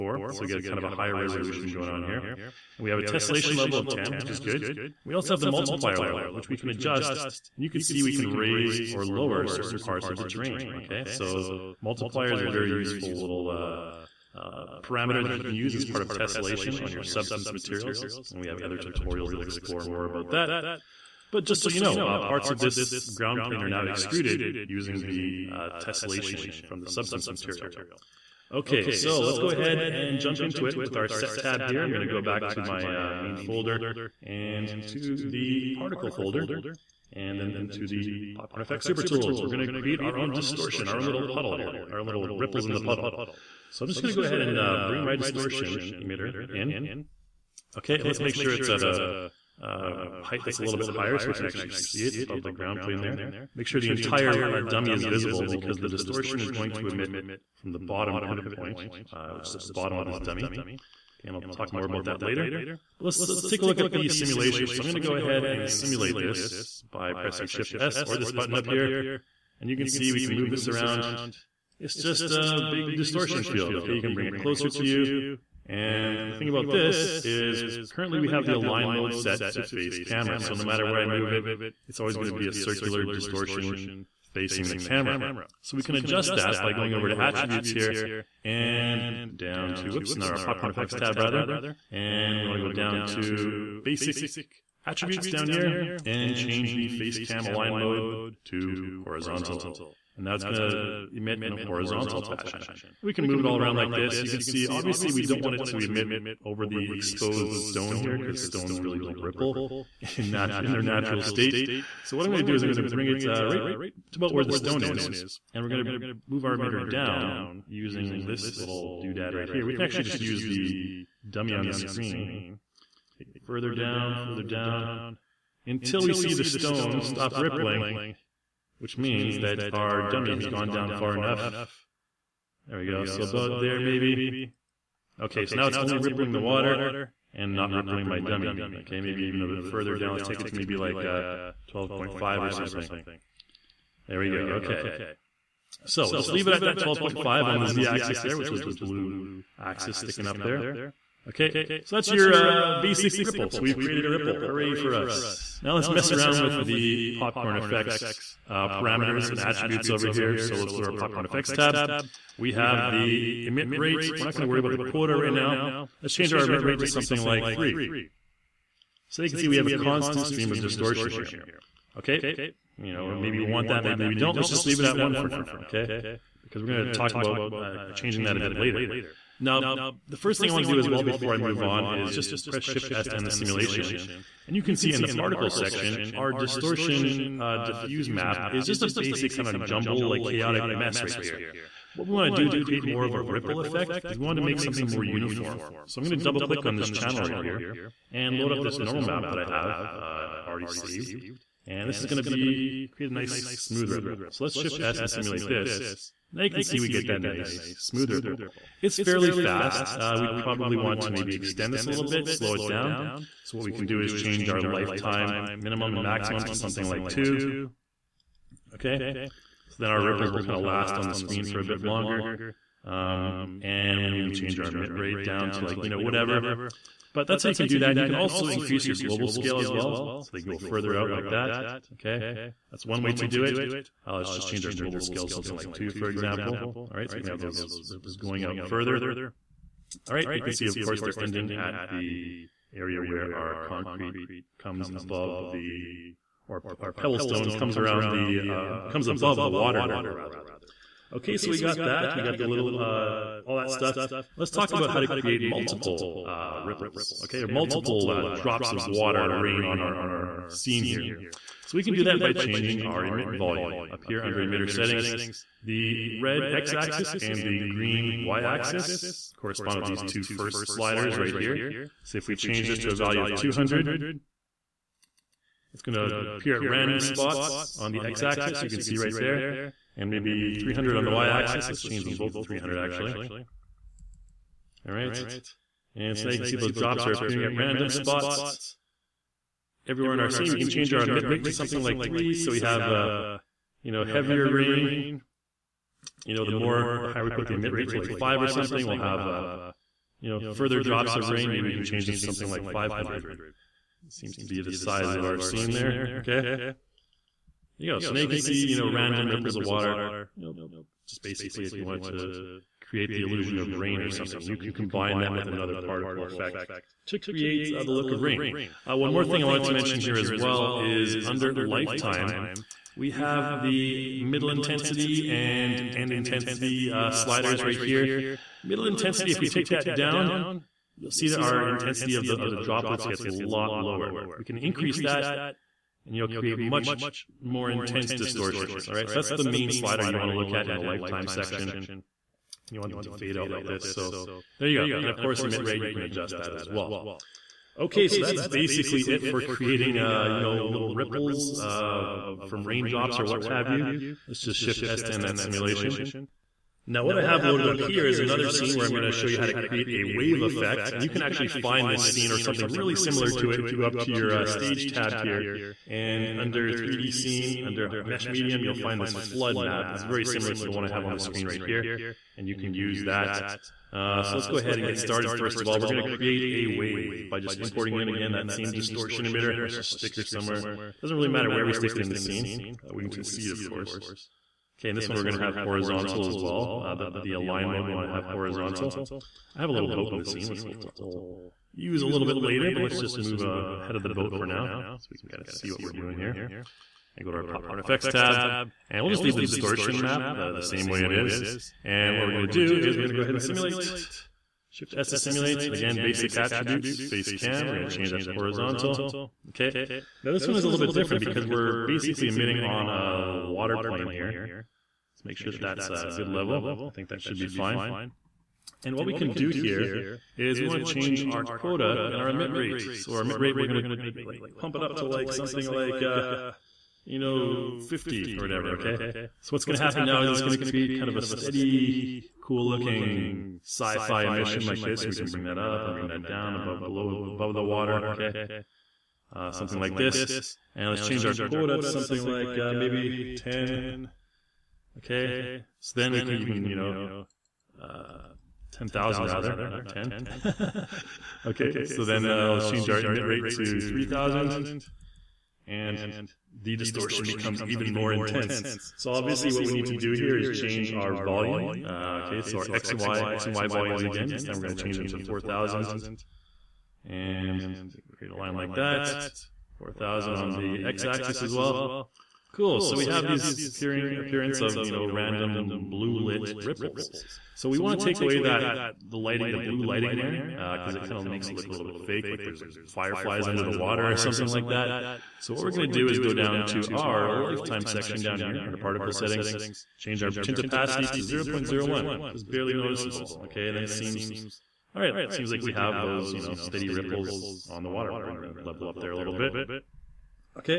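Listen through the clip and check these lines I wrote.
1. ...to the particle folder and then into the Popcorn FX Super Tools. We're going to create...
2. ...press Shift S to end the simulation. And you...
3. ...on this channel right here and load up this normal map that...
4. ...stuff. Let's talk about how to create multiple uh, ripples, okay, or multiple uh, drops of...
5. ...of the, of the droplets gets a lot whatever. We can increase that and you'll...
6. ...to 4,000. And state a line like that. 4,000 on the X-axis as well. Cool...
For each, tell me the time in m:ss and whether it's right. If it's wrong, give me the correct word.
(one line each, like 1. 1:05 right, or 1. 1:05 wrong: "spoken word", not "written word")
1. 0:34 right
2. 3:02 right
3. 3:16 right
4. 4:13 right
5. 5:32 wrong: "lower", not "whatever"
6. 7:45 wrong: "create", not "state".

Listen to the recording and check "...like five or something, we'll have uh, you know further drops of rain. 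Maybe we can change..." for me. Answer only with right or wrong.
right.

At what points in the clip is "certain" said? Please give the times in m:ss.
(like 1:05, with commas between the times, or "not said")
0:09.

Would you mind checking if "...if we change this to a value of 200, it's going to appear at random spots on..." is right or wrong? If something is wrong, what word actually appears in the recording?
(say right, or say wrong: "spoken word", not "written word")
right.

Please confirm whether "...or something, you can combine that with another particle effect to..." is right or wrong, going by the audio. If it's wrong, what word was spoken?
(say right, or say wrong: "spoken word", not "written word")
right.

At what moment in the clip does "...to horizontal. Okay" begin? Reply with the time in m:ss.
6:48.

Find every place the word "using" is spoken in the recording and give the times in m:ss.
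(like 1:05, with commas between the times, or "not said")
0:24, 1:57.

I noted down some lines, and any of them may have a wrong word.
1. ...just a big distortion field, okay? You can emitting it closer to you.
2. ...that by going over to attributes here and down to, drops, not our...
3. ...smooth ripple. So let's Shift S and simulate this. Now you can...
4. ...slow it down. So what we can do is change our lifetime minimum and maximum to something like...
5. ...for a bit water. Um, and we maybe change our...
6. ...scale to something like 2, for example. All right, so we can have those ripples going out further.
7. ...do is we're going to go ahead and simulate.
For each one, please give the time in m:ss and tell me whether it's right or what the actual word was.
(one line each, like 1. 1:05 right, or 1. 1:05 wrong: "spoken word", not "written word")
1. 1:11 wrong: "bring", not "emitting"
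2. 1:26 wrong: "whoops", not "drops"
3. 3:23 right
4. 3:32 right
5. 3:41 wrong: "longer", not "water"
6. 3:54 right
7. 6:42 right.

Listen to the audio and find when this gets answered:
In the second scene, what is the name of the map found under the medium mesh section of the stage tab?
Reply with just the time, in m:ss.
6:09.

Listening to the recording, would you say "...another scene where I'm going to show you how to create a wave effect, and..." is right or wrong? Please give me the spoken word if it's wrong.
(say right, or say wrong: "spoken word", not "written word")
right.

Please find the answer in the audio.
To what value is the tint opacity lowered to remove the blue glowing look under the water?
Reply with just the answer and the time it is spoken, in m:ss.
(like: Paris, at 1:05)
0.01, at 8:11.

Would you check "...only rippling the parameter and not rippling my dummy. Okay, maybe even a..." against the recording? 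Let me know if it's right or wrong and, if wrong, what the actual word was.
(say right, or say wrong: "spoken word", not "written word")
wrong: "water", not "parameter".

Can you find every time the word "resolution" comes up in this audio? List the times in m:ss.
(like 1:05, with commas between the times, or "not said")
0:01.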